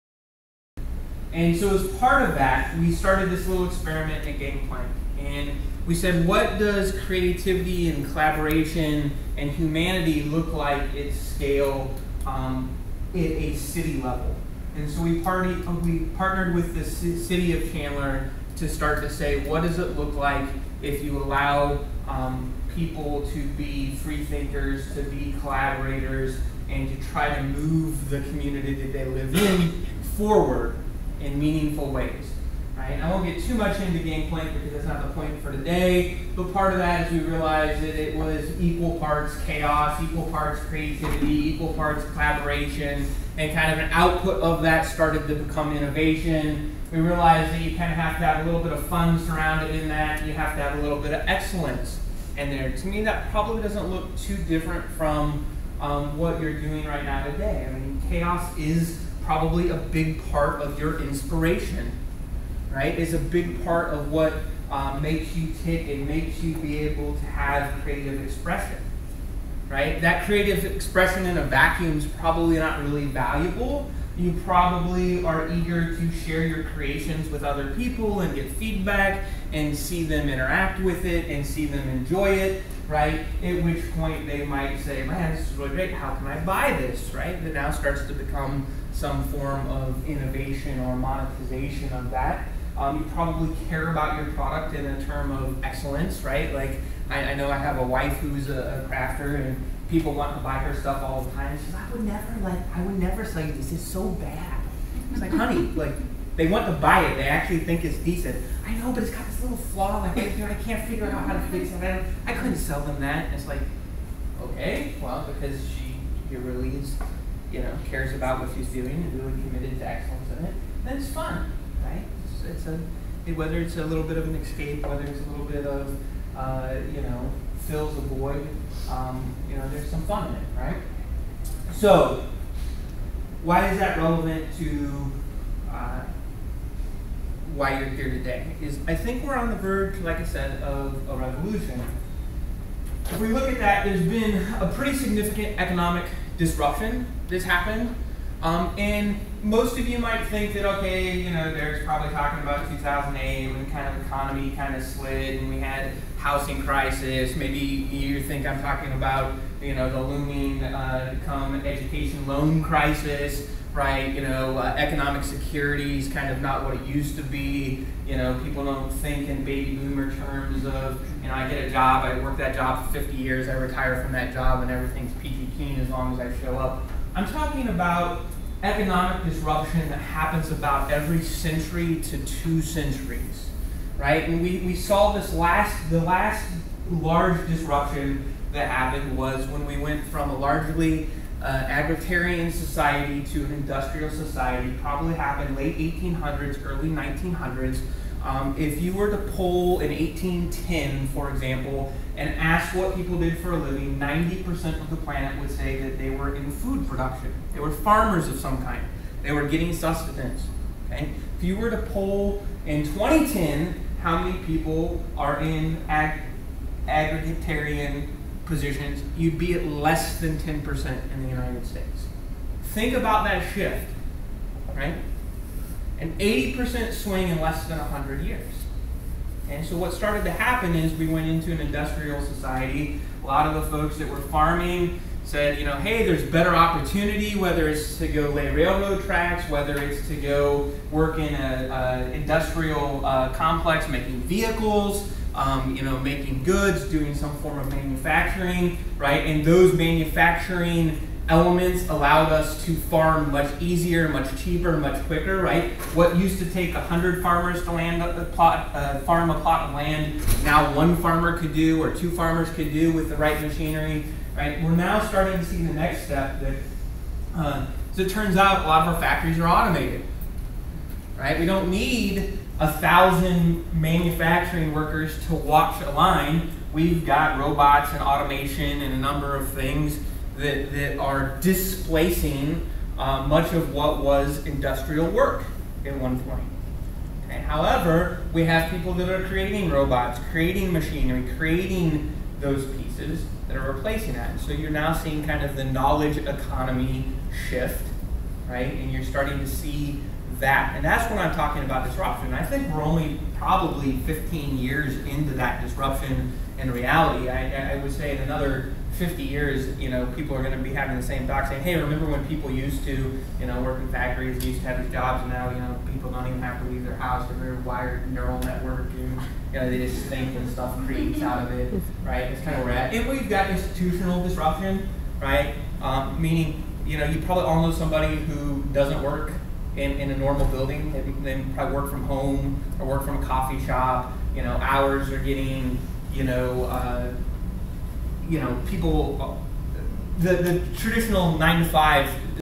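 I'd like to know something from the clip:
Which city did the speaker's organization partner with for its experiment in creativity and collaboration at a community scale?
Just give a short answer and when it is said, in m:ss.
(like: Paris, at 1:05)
Chandler, at 0:17.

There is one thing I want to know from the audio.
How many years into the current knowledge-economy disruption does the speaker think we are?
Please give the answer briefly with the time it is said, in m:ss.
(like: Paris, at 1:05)
15, at 5:03.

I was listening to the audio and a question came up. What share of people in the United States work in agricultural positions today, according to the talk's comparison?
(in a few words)
less than 10%.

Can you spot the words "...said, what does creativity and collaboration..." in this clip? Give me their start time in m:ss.
0:05.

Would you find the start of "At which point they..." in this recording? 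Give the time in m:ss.
1:23.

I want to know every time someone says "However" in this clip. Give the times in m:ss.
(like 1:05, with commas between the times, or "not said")
4:47.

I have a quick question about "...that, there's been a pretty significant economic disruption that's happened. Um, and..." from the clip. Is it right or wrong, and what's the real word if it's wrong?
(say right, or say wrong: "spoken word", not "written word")
right.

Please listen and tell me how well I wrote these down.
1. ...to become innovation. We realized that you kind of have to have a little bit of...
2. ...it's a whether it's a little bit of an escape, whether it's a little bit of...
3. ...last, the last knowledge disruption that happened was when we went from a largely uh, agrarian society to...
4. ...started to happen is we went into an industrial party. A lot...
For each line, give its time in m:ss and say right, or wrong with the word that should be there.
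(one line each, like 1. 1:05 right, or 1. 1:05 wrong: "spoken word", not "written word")
1. 0:45 right
2. 2:02 right
3. 3:05 wrong: "large", not "knowledge"
4. 3:49 wrong: "society", not "party".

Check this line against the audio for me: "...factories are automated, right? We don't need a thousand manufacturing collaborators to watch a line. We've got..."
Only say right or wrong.
wrong.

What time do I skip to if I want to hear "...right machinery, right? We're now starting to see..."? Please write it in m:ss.
4:23.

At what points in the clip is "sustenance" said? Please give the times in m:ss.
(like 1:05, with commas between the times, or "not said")
3:29.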